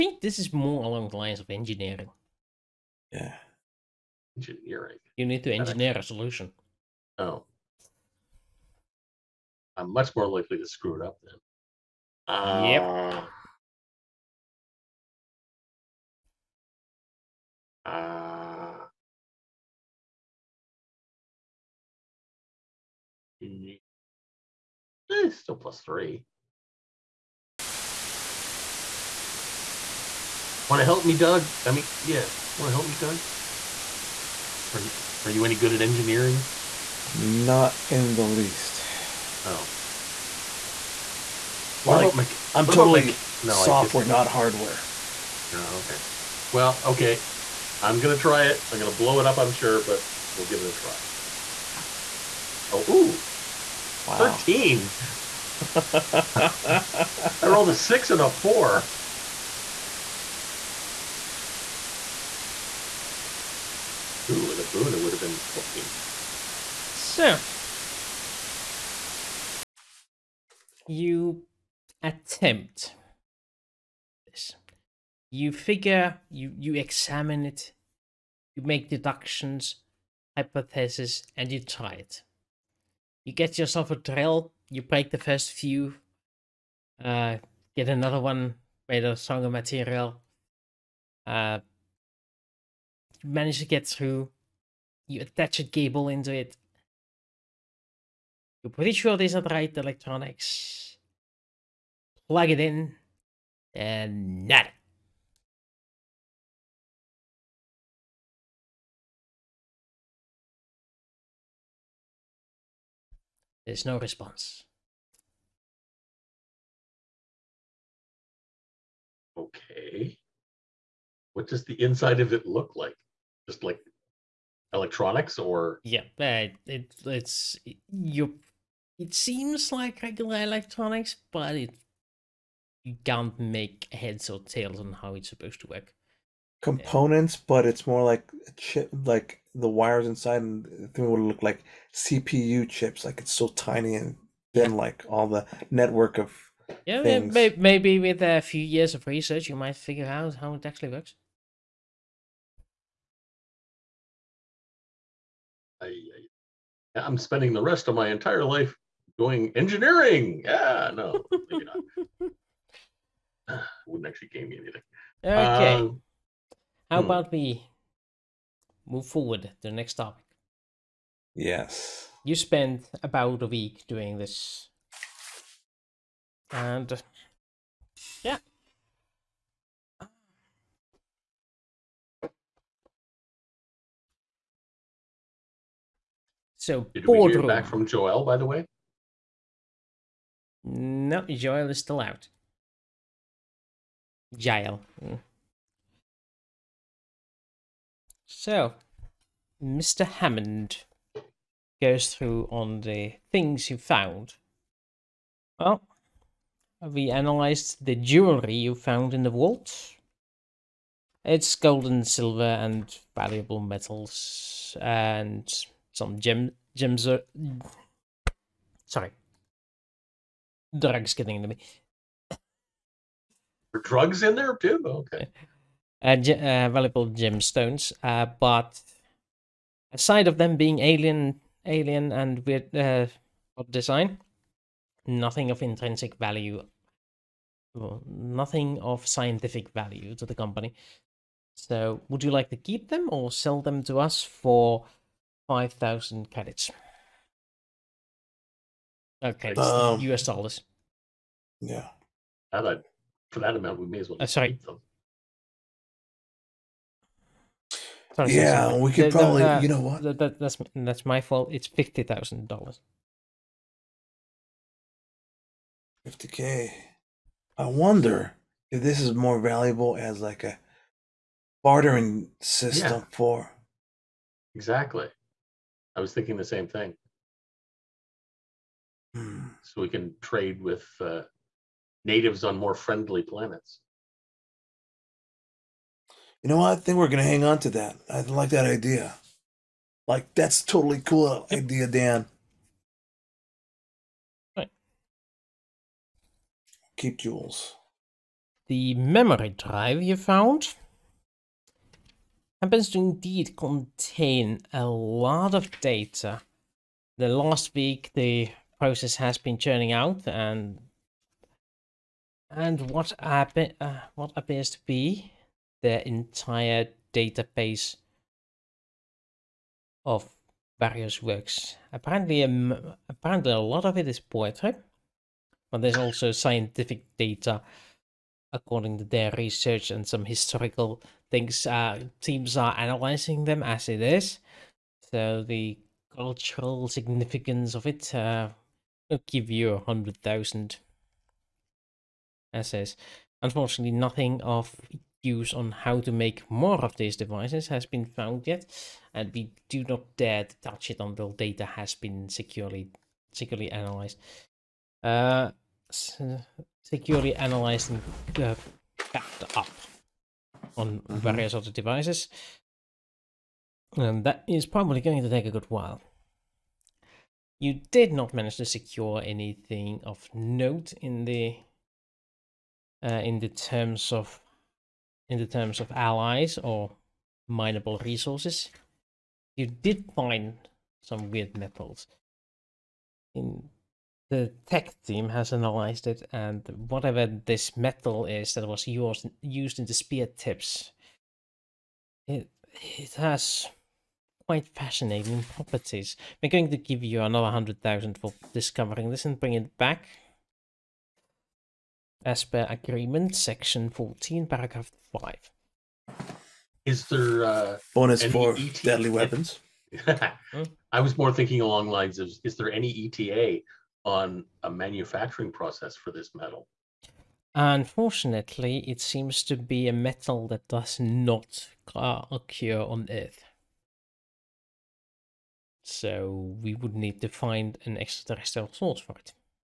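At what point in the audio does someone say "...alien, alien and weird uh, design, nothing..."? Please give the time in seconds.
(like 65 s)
230 s.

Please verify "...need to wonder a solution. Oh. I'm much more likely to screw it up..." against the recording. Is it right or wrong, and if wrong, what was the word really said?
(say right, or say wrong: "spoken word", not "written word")
wrong: "engineer", not "wonder".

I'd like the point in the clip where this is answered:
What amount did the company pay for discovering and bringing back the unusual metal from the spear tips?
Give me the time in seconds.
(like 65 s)
397 s.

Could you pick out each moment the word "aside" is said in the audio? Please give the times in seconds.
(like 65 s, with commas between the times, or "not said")
229 s.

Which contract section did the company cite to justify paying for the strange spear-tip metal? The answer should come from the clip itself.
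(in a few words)
section 14.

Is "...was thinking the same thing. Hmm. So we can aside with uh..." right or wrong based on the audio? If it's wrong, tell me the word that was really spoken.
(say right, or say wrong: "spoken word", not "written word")
wrong: "trade", not "aside".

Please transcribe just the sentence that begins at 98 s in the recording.
You're pretty sure there's not right electronics.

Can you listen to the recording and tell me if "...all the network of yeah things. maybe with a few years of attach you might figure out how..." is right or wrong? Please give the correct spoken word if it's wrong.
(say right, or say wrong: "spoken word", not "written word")
wrong: "research", not "attach".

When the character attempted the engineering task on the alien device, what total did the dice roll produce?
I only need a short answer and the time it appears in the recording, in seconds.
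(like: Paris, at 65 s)
13, at 54 s.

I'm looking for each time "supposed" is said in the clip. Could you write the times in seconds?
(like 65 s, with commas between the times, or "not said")
135 s.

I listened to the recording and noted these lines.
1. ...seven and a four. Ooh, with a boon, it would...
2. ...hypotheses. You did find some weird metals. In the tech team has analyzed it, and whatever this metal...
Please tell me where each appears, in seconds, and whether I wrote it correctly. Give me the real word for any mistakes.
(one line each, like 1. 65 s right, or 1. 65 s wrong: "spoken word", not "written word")
1. 57 s wrong: "six", not "seven"
2. 378 s wrong: "resources", not "hypotheses".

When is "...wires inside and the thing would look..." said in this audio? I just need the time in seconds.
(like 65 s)
139 s.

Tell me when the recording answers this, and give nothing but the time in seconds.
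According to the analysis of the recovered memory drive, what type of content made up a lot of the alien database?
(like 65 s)
324 s.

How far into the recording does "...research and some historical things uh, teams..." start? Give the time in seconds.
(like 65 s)
329 s.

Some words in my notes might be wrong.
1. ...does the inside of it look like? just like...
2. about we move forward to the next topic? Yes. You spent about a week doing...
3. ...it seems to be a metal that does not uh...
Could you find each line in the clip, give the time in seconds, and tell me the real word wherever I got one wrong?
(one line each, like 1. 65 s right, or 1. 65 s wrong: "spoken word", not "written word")
1. 121 s right
2. 167 s right
3. 418 s right.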